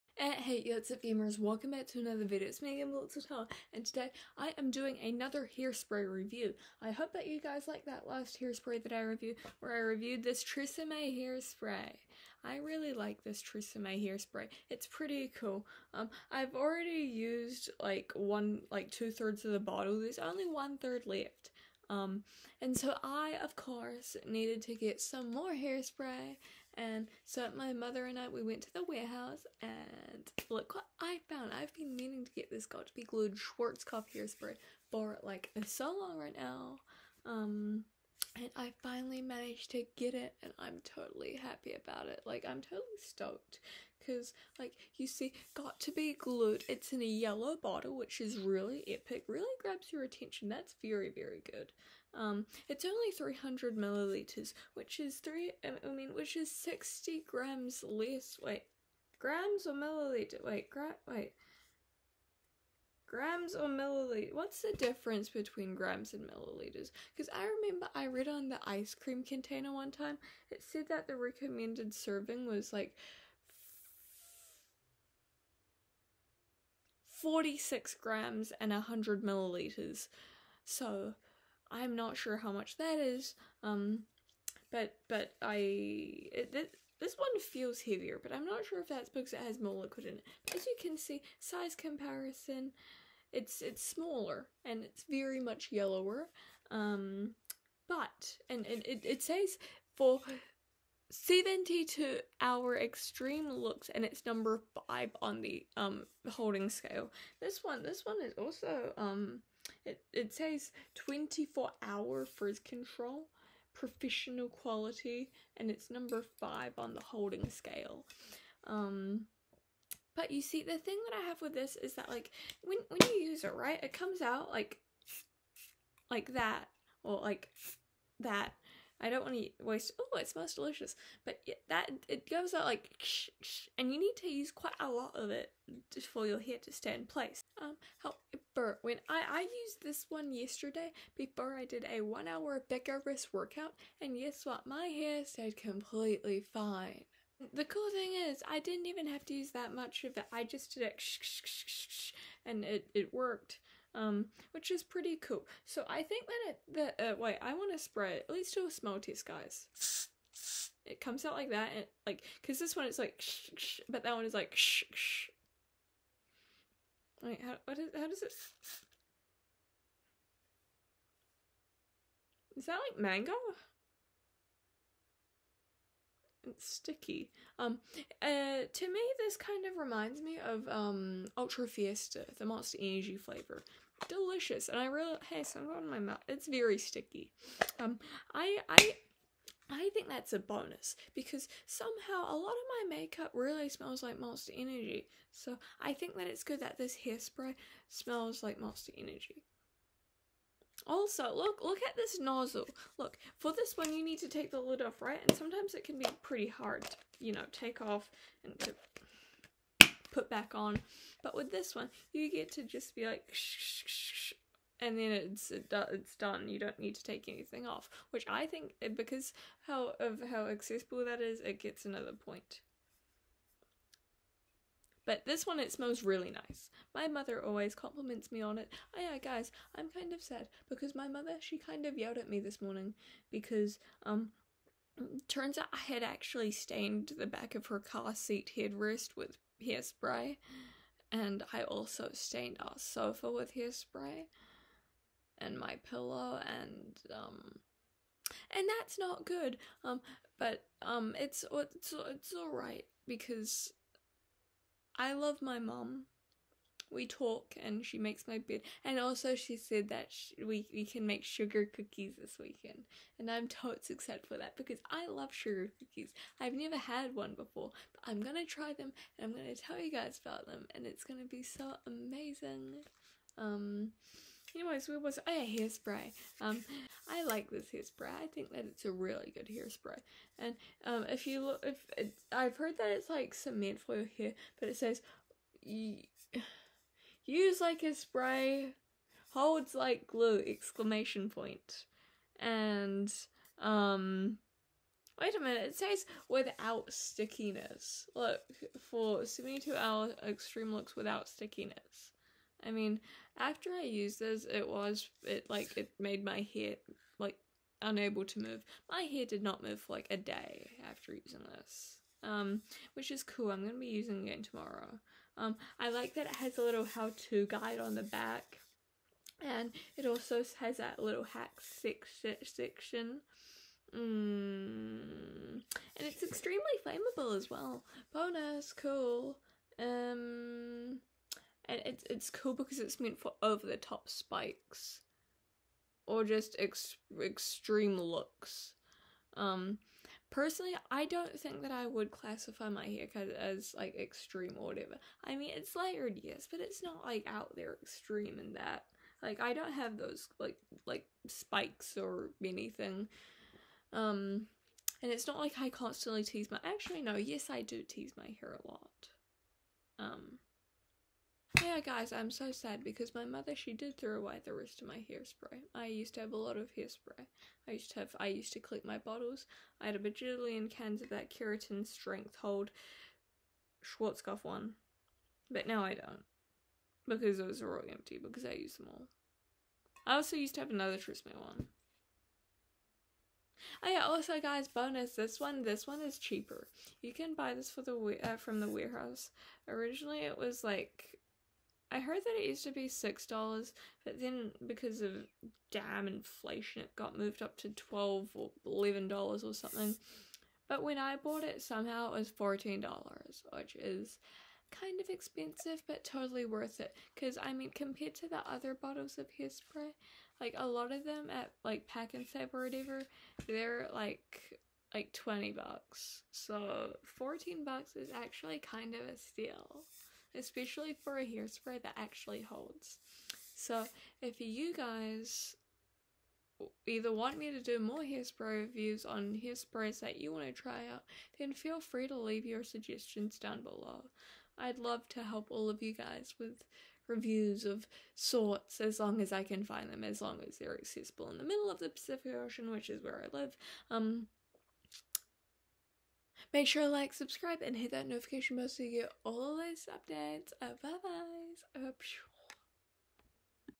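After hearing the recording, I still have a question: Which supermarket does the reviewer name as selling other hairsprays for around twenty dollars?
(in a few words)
Pak'nSave.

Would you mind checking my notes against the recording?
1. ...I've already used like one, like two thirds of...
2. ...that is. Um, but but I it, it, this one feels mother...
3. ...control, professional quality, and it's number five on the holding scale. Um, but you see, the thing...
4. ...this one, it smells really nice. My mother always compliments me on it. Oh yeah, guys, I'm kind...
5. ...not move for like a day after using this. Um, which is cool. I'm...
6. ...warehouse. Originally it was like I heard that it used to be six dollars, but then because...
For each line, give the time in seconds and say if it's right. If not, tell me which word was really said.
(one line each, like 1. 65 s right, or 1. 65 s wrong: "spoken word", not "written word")
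1. 16 s right
2. 82 s wrong: "heavier", not "mother"
3. 112 s right
4. 225 s right
5. 309 s right
6. 388 s right.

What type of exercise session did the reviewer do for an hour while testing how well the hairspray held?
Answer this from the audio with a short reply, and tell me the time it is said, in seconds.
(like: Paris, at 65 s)
Vigorous wrist workout, at 142 s.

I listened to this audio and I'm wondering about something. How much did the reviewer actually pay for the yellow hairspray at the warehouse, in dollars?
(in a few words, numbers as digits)
14.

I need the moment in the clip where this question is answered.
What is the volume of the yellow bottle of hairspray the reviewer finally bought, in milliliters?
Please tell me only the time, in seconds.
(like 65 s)
53 s.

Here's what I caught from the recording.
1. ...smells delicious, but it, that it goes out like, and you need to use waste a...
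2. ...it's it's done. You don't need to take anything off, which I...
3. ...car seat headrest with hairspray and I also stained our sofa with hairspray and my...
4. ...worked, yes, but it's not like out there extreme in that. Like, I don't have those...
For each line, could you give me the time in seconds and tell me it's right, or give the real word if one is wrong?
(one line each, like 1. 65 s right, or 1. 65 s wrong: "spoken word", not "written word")
1. 130 s wrong: "quite", not "waste"
2. 215 s right
3. 237 s right
4. 345 s wrong: "layered", not "worked".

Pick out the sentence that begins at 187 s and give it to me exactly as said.
Um, I I I think that's a bonus because somehow a lot of my makeup really smells like Monster Energy.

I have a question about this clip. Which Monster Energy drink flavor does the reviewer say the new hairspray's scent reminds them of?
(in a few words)
Ultra Fiesta.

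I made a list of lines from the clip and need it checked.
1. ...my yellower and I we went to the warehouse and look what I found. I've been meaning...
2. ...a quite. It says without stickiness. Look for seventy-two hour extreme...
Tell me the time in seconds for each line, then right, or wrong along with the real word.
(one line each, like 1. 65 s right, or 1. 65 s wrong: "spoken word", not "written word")
1. 27 s wrong: "mother", not "yellower"
2. 295 s wrong: "minute", not "quite".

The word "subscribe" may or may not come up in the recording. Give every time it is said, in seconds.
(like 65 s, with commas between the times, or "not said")
447 s.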